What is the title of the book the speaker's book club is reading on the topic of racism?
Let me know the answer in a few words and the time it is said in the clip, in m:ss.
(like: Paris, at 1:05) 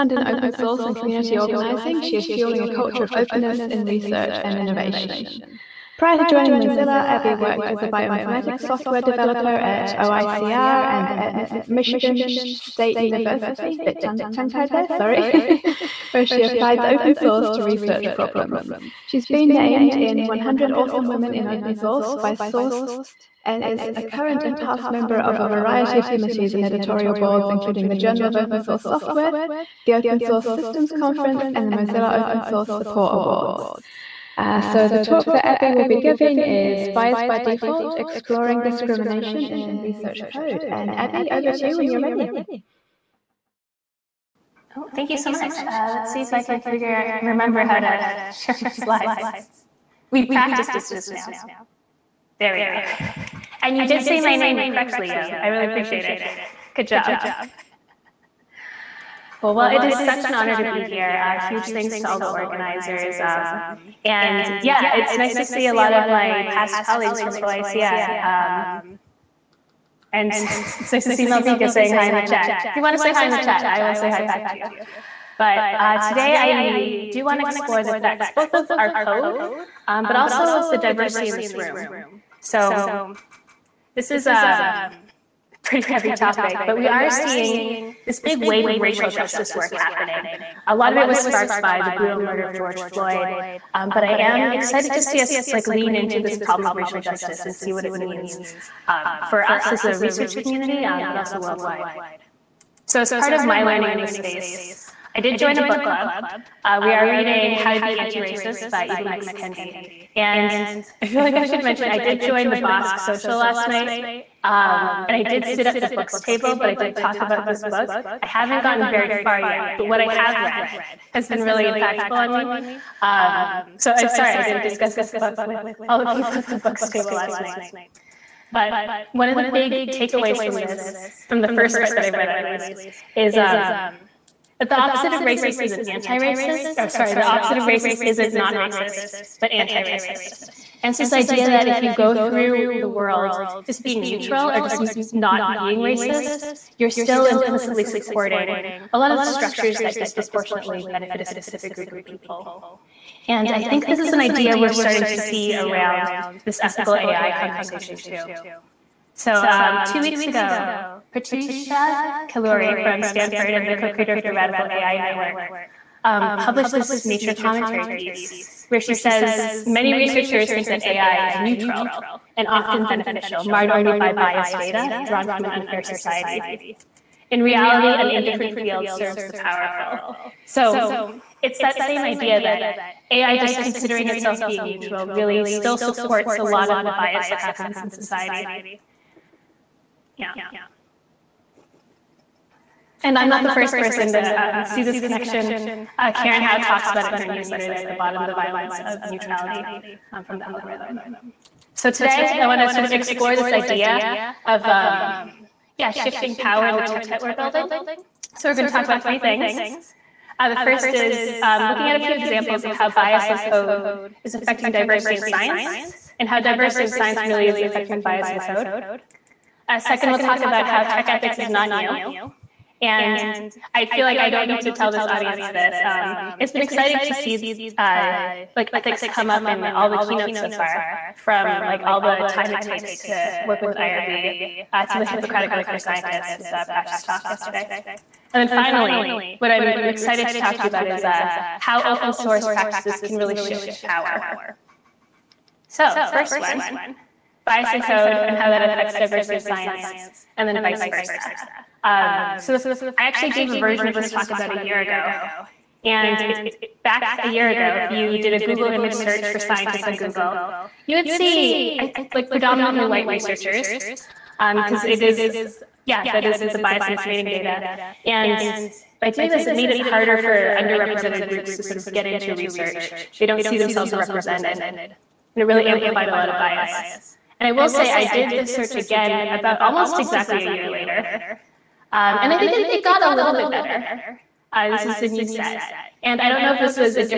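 How to Be Anti-Racist, at 1:47.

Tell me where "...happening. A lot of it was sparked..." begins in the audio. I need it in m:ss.
1:29.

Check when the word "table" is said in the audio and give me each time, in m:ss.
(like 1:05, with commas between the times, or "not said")
1:56, 2:06.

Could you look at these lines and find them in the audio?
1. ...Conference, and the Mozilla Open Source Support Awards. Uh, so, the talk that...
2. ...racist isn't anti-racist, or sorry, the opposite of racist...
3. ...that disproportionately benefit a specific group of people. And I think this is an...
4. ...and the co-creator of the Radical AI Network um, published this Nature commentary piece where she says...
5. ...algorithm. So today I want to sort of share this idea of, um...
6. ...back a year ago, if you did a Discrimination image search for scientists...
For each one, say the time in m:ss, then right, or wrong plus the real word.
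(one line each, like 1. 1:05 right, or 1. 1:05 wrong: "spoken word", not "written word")
1. 0:30 right
2. 2:15 right
3. 2:29 right
4. 2:43 right
5. 3:20 wrong: "explore", not "share"
6. 4:16 wrong: "Google", not "Discrimination".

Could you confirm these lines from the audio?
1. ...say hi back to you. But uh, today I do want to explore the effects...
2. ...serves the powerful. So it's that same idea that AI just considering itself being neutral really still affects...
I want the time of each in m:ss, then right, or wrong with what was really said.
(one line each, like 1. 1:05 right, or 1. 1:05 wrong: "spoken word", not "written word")
1. 1:13 right
2. 2:58 wrong: "supports", not "affects".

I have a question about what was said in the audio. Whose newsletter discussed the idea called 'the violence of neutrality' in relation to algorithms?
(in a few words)
Karen Hao.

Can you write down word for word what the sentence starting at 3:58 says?
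And then finally, what I'm excited to talk to you about is uh, how open source practices can really shift power.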